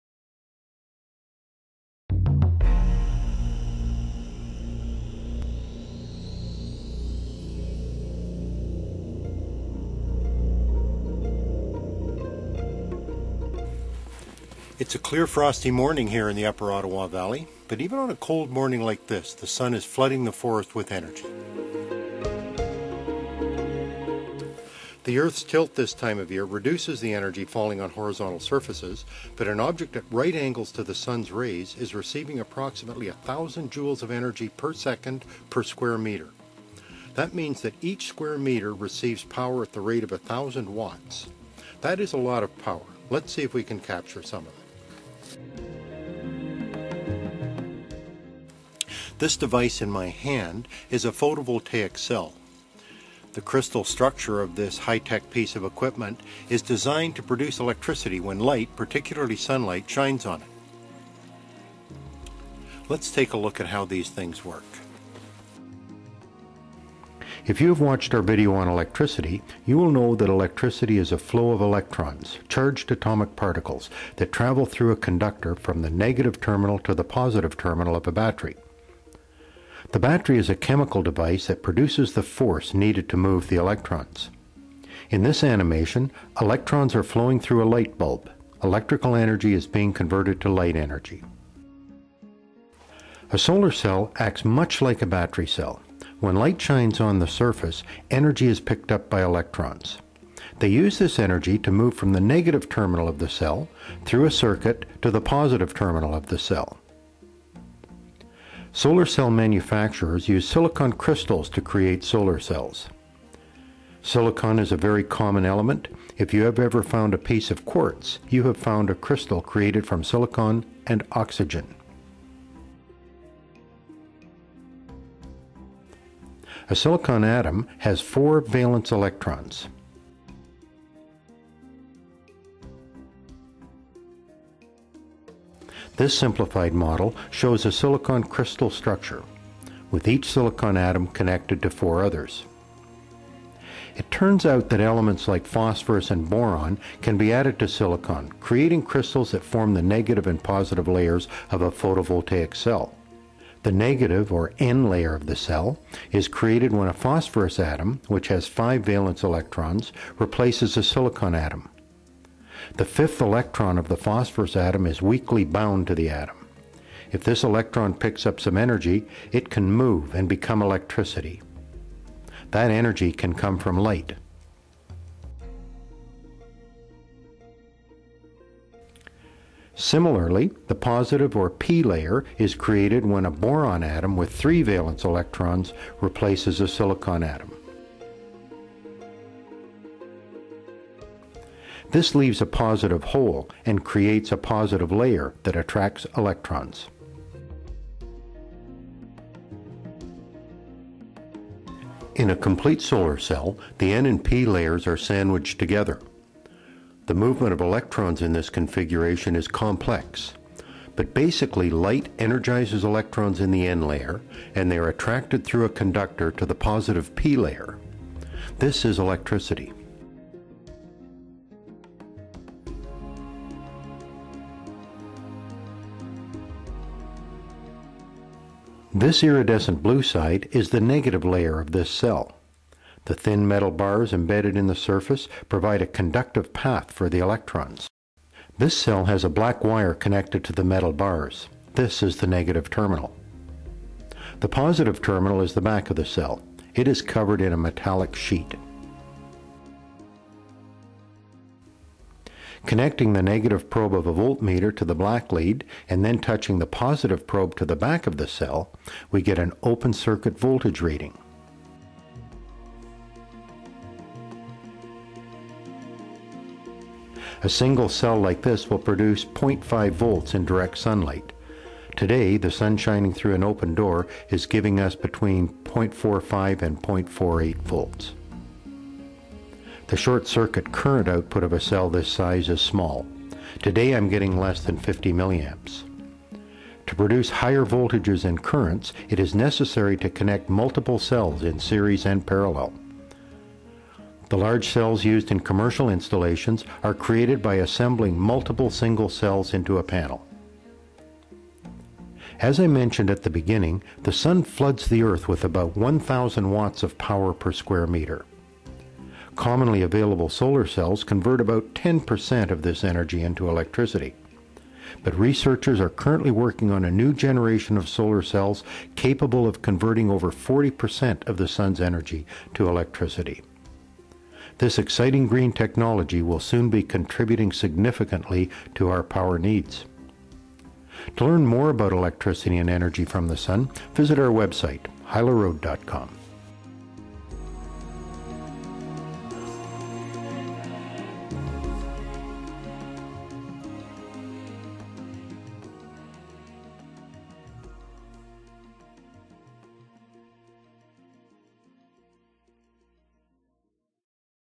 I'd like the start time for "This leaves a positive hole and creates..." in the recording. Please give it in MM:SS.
03:11.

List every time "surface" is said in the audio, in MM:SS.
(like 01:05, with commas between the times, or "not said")
00:28, 01:37, 03:54.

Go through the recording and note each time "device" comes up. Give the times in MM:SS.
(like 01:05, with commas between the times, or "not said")
00:49, 01:21.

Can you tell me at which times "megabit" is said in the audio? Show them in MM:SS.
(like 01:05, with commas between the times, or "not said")
not said.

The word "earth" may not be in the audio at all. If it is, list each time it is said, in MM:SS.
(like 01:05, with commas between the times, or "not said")
00:25, 05:05.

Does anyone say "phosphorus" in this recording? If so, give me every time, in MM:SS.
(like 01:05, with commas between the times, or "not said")
02:25, 02:36, 02:43.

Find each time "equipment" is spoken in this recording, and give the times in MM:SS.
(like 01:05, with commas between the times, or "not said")
00:55.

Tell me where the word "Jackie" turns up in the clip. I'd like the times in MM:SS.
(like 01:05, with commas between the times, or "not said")
not said.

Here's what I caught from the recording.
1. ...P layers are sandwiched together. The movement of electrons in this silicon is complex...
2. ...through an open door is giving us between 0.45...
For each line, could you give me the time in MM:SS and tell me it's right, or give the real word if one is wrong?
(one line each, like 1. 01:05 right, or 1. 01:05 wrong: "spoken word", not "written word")
1. 03:24 wrong: "configuration", not "silicon"
2. 04:33 right.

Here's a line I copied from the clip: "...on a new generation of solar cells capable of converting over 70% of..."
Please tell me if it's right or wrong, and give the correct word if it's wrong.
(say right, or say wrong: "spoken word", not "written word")
wrong: "40", not "70".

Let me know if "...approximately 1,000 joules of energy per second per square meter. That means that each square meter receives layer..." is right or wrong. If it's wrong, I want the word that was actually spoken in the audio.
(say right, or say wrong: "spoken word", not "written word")
wrong: "power", not "layer".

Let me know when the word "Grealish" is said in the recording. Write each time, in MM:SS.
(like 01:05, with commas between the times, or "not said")
not said.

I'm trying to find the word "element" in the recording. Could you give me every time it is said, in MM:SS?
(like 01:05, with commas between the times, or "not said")
01:55, 02:24.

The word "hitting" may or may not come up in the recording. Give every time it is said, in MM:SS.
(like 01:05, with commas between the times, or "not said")
not said.